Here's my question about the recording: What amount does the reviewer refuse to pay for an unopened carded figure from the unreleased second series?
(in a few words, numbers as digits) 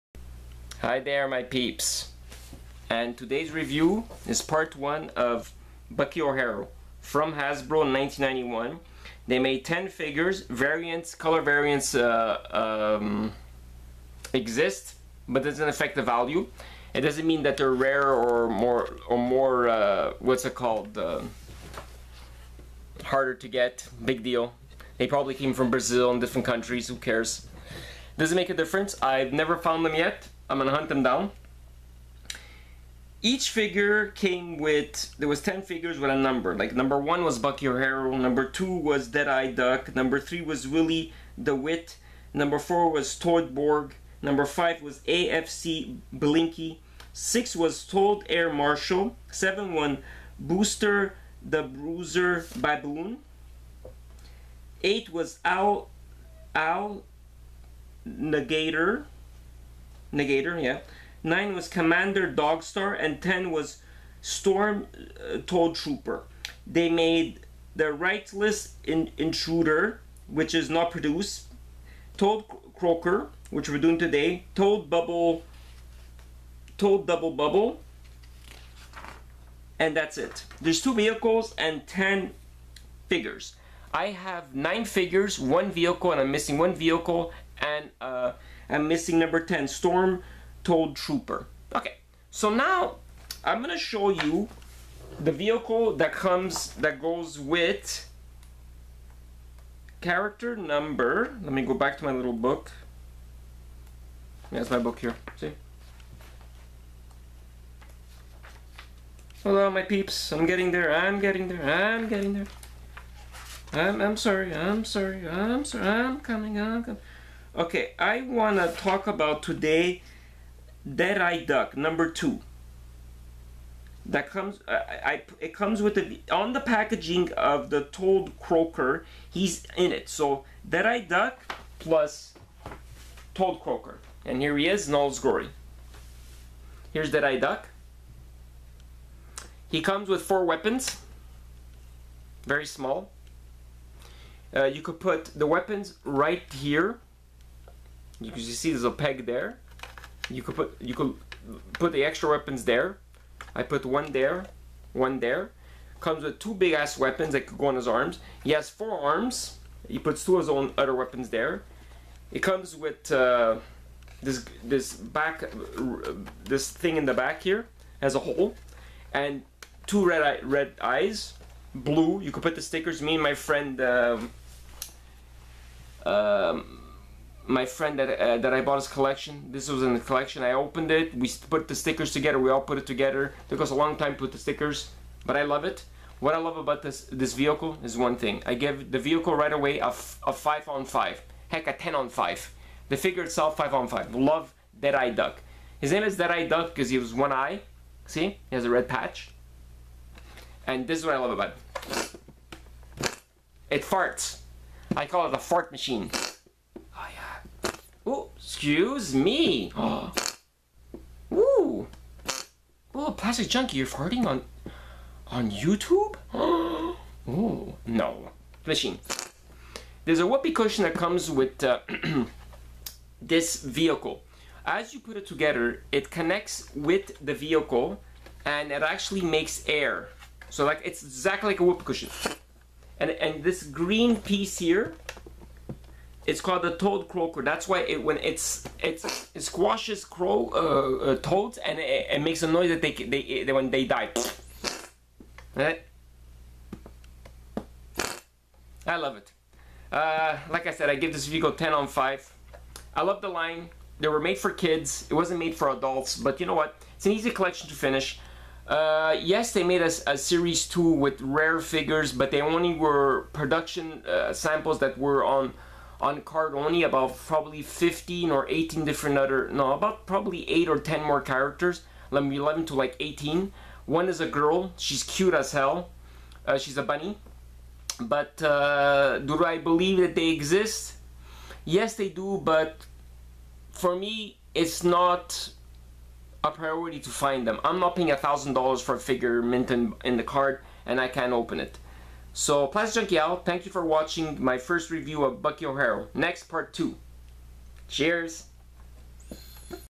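$1,000.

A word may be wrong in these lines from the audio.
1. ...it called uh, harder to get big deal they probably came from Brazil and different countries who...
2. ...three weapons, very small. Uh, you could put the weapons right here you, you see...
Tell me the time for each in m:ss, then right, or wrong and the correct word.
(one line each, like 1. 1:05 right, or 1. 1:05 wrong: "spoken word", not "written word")
1. 0:20 right
2. 2:20 wrong: "four", not "three".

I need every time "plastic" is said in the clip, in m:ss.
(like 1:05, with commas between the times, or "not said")
3:33, 4:52.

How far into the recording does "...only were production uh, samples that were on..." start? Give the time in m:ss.
4:22.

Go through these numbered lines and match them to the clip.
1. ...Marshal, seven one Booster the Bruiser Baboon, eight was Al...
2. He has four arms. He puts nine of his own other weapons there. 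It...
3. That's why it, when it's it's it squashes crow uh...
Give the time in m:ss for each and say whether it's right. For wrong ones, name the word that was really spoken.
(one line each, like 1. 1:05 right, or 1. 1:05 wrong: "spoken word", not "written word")
1. 0:48 right
2. 2:38 wrong: "two", not "nine"
3. 3:57 right.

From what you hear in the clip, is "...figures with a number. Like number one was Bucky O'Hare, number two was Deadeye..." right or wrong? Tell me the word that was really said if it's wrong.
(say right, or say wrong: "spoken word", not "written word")
right.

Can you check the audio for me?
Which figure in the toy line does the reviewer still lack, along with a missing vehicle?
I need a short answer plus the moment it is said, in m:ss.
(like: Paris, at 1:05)
Storm Toad Trooper, at 1:29.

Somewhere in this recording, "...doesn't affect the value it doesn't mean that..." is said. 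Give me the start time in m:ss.
0:15.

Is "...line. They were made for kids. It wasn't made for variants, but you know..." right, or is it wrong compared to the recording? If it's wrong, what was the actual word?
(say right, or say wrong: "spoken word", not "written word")
wrong: "adults", not "variants".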